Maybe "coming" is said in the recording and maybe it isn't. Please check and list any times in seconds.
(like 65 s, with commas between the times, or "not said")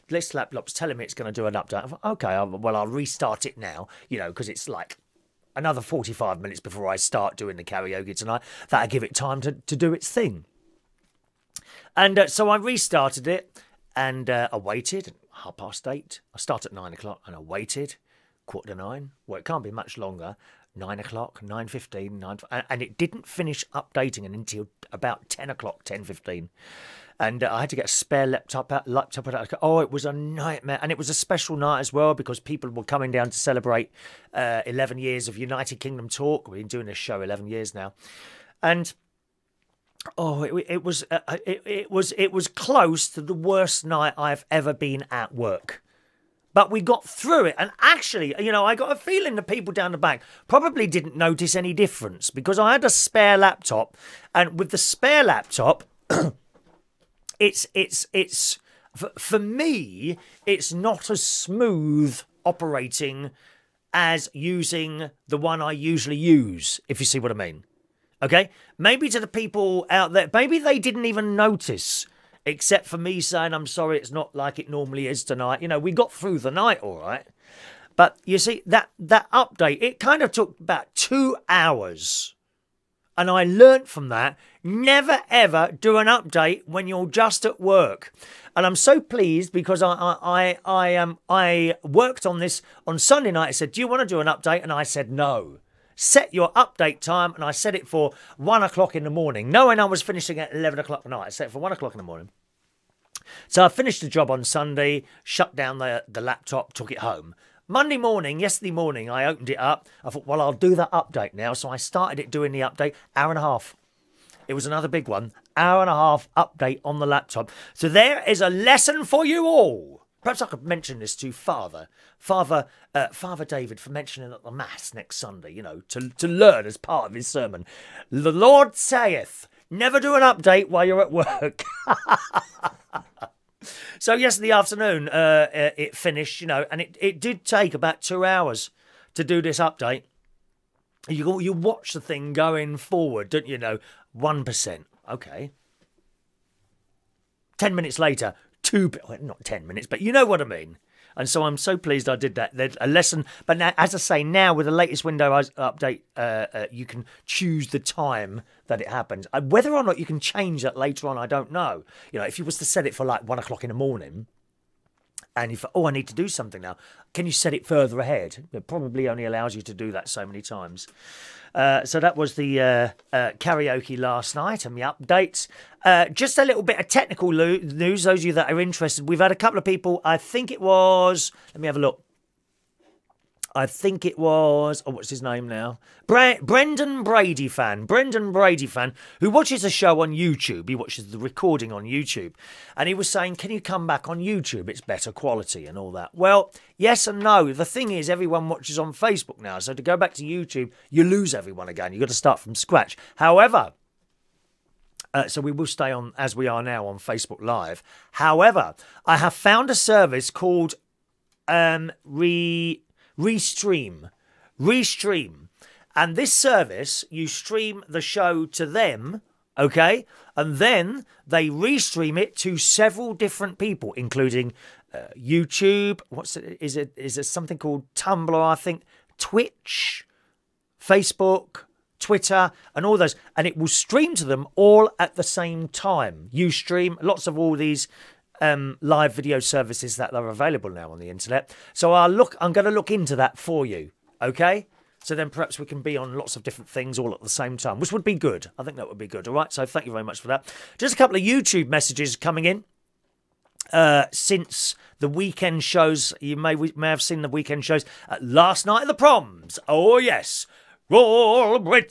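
32 s, 252 s.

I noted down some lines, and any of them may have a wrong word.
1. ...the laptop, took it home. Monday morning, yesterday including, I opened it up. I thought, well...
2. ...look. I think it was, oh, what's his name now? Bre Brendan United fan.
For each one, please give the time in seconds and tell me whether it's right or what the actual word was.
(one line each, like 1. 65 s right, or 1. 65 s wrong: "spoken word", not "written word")
1. 106 s wrong: "morning", not "including"
2. 181 s wrong: "Brady", not "United".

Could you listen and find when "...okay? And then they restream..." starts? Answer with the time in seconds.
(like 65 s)
219 s.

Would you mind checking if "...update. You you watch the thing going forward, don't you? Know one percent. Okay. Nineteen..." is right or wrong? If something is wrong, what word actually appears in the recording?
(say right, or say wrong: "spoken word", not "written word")
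wrong: "Ten", not "Nineteen".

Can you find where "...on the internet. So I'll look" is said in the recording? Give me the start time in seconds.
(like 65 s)
240 s.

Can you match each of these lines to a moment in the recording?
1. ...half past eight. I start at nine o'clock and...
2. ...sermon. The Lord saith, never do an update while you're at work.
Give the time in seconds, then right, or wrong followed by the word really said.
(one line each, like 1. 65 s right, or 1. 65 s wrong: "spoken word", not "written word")
1. 15 s right
2. 127 s right.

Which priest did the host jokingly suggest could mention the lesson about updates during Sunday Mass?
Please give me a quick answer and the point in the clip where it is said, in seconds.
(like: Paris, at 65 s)
Father David, at 123 s.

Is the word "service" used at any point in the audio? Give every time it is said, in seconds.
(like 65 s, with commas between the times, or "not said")
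209 s, 216 s, 239 s.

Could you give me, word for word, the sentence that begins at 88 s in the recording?
And I'm so pleased because I I I, I um I worked on this on Sunday night.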